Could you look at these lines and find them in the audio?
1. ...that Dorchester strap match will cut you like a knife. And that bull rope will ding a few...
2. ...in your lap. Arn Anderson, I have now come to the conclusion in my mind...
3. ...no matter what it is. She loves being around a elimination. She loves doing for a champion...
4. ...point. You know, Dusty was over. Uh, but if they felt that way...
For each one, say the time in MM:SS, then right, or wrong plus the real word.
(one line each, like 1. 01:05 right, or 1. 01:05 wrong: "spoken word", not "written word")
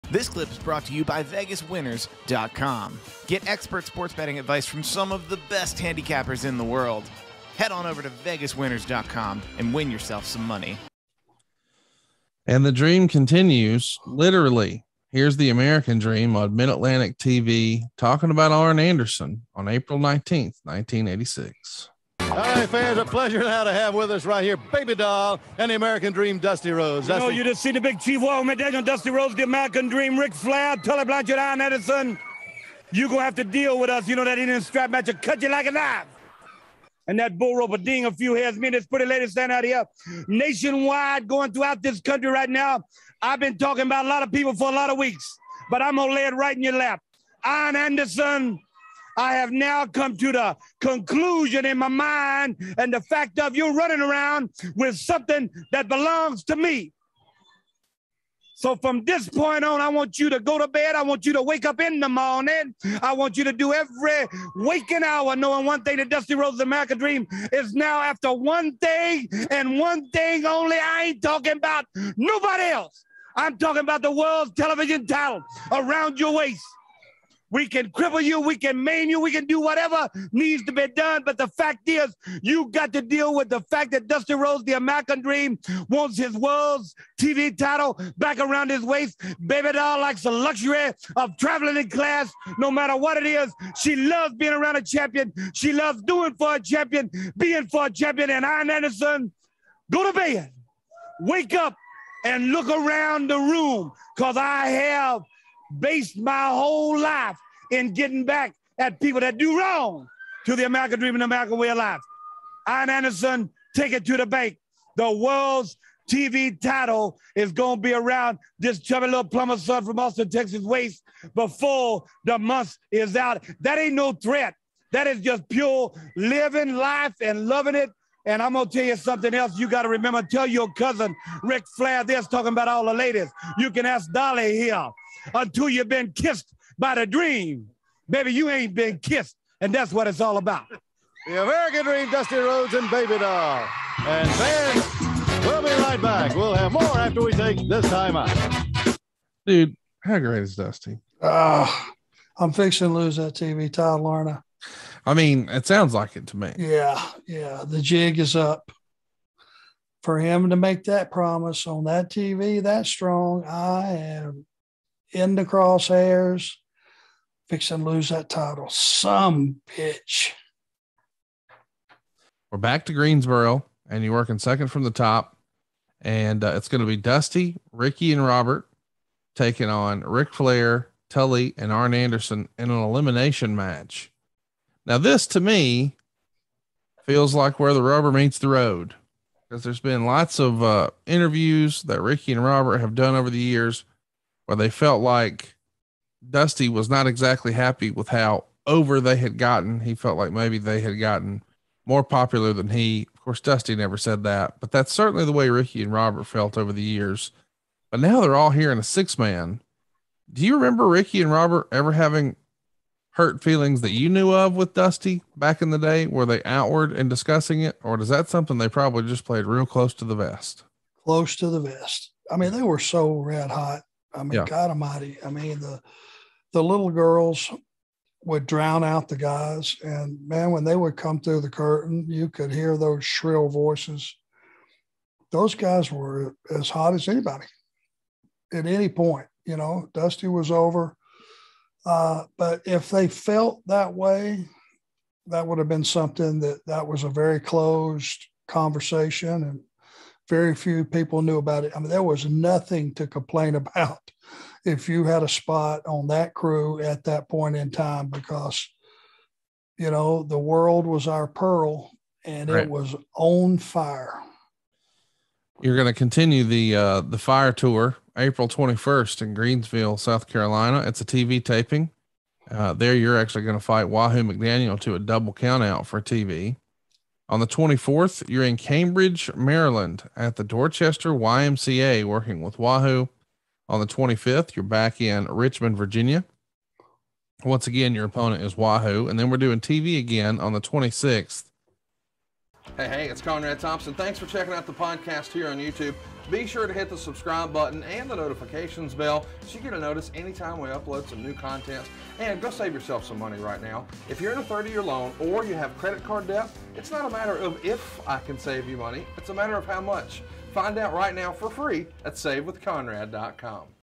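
1. 00:34 wrong: "Indian", not "Dorchester"
2. 00:46 right
3. 01:32 wrong: "champion", not "elimination"
4. 03:58 right.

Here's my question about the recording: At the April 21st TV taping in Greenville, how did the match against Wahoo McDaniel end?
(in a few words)
Double countout.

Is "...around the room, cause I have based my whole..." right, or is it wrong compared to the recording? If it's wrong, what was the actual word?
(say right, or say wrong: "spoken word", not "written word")
right.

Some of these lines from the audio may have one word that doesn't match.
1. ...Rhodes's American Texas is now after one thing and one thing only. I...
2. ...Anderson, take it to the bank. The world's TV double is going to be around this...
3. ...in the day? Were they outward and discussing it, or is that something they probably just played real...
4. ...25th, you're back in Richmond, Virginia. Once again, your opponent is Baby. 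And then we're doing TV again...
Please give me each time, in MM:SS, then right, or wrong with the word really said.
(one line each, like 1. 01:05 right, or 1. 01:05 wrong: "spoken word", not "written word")
1. 01:06 wrong: "Dream", not "Texas"
2. 01:52 wrong: "title", not "double"
3. 03:35 right
4. 04:43 wrong: "Wahoo", not "Baby".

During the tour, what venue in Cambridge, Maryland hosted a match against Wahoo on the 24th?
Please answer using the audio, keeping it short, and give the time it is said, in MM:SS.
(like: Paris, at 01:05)
Dorchester YMCA, at 04:40.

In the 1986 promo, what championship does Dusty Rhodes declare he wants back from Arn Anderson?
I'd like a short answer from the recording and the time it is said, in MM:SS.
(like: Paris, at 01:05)
World's television title, at 01:14.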